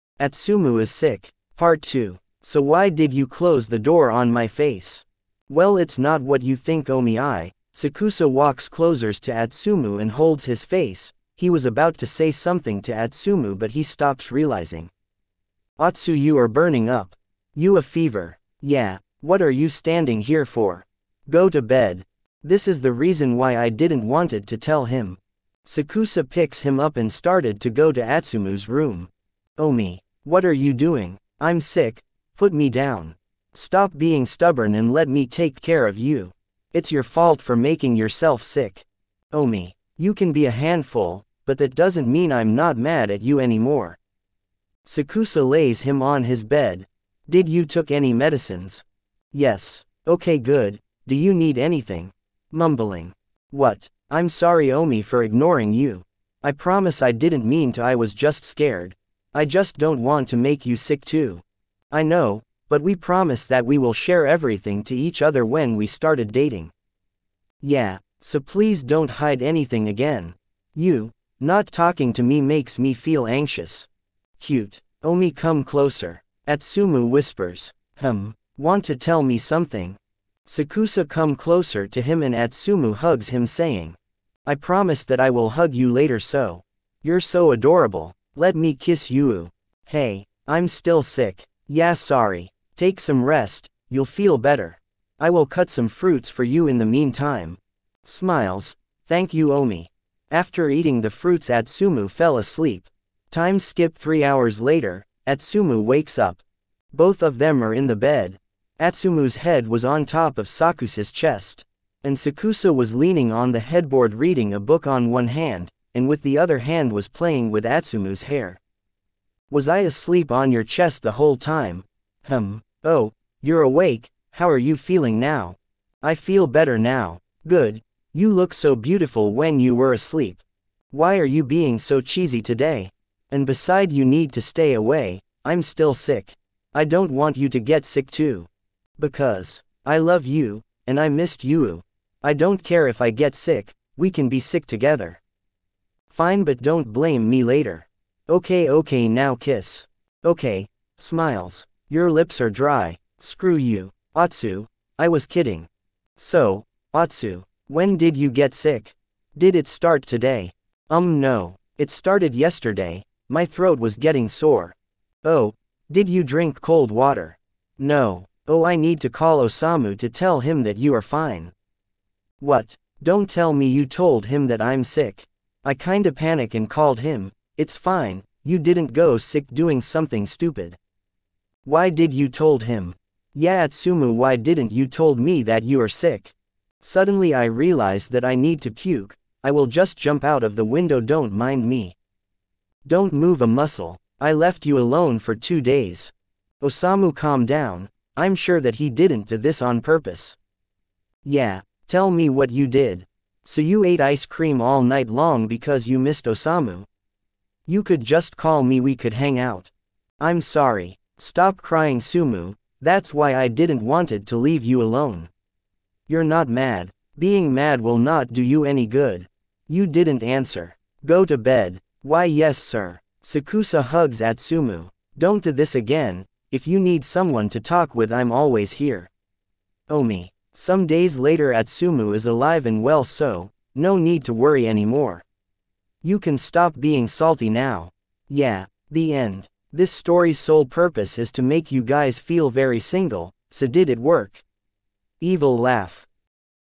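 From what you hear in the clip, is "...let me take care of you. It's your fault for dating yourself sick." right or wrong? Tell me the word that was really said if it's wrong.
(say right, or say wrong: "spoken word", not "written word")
wrong: "making", not "dating".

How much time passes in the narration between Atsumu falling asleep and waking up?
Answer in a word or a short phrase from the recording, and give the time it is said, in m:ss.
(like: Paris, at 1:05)
Three hours, at 1:43.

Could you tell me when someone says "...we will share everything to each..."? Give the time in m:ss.
1:03.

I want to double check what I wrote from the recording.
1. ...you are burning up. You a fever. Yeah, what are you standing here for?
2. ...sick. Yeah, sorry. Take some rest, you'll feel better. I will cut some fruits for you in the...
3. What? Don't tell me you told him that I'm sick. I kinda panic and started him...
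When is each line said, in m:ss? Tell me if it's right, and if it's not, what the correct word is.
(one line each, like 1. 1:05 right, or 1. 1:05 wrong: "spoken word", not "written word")
1. 0:16 right
2. 1:31 right
3. 2:52 wrong: "called", not "started".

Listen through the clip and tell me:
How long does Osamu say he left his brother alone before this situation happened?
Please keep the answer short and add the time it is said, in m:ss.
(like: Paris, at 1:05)
Two days, at 3:15.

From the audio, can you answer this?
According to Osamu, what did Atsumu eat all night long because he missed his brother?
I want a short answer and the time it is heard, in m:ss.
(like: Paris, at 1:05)
Ice cream, at 3:24.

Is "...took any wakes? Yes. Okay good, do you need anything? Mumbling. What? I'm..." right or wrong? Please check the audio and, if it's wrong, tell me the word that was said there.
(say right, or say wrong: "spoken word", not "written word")
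wrong: "medicines", not "wakes".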